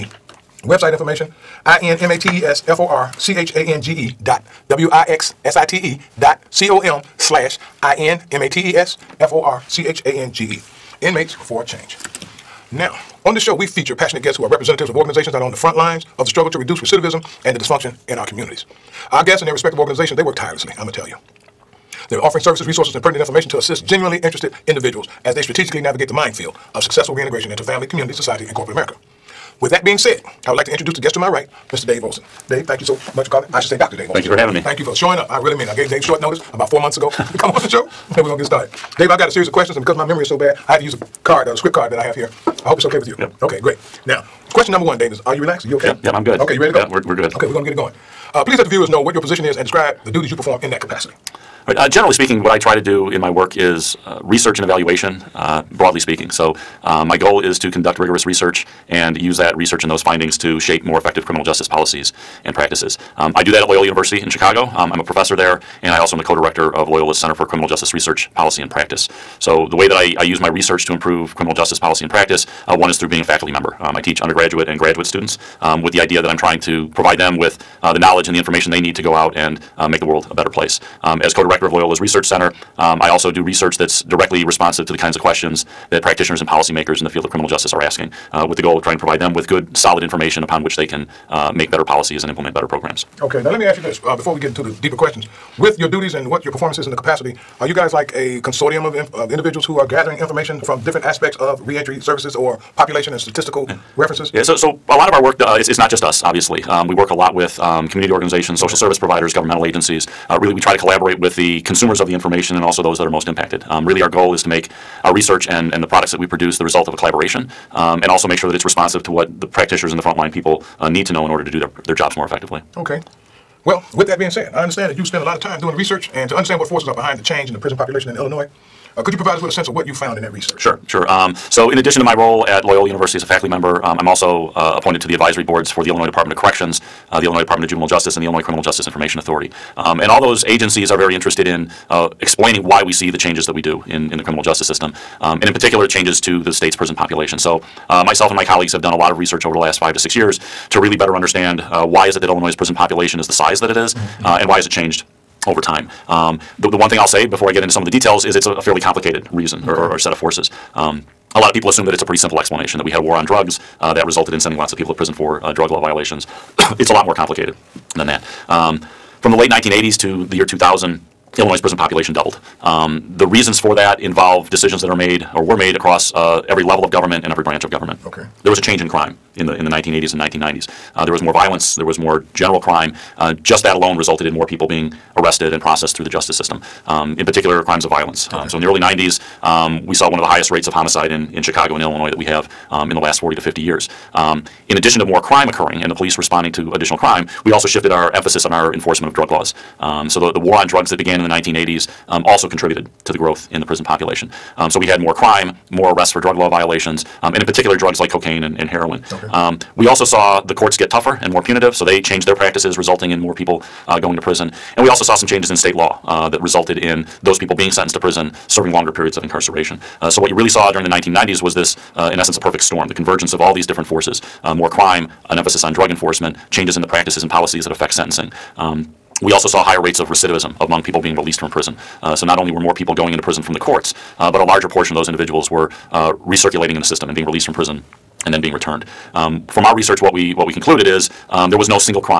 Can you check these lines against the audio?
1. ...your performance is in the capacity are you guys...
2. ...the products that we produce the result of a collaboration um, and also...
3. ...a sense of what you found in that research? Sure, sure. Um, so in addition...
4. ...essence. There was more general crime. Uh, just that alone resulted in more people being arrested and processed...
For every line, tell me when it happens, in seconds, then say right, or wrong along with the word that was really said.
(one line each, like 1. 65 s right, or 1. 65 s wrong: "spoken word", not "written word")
1. 96 s right
2. 115 s right
3. 129 s right
4. 181 s wrong: "violence", not "essence".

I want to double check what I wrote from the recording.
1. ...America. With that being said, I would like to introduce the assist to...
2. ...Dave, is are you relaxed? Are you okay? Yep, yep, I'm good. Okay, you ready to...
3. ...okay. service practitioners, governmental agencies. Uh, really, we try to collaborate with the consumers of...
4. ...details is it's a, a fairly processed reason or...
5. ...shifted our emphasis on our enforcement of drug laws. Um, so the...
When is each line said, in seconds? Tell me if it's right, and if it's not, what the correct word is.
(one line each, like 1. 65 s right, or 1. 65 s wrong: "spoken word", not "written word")
1. 28 s wrong: "guest", not "assist"
2. 44 s right
3. 108 s wrong: "providers", not "practitioners"
4. 157 s wrong: "complicated", not "processed"
5. 197 s right.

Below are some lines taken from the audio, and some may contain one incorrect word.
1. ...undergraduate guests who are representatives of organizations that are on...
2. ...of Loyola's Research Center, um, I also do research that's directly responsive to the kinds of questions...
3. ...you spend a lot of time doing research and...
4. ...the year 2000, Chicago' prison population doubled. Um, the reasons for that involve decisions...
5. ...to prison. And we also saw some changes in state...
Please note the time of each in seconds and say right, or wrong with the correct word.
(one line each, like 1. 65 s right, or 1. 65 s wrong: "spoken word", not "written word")
1. 13 s wrong: "passionate", not "undergraduate"
2. 81 s right
3. 124 s right
4. 170 s wrong: "Illinois", not "Chicago"
5. 214 s right.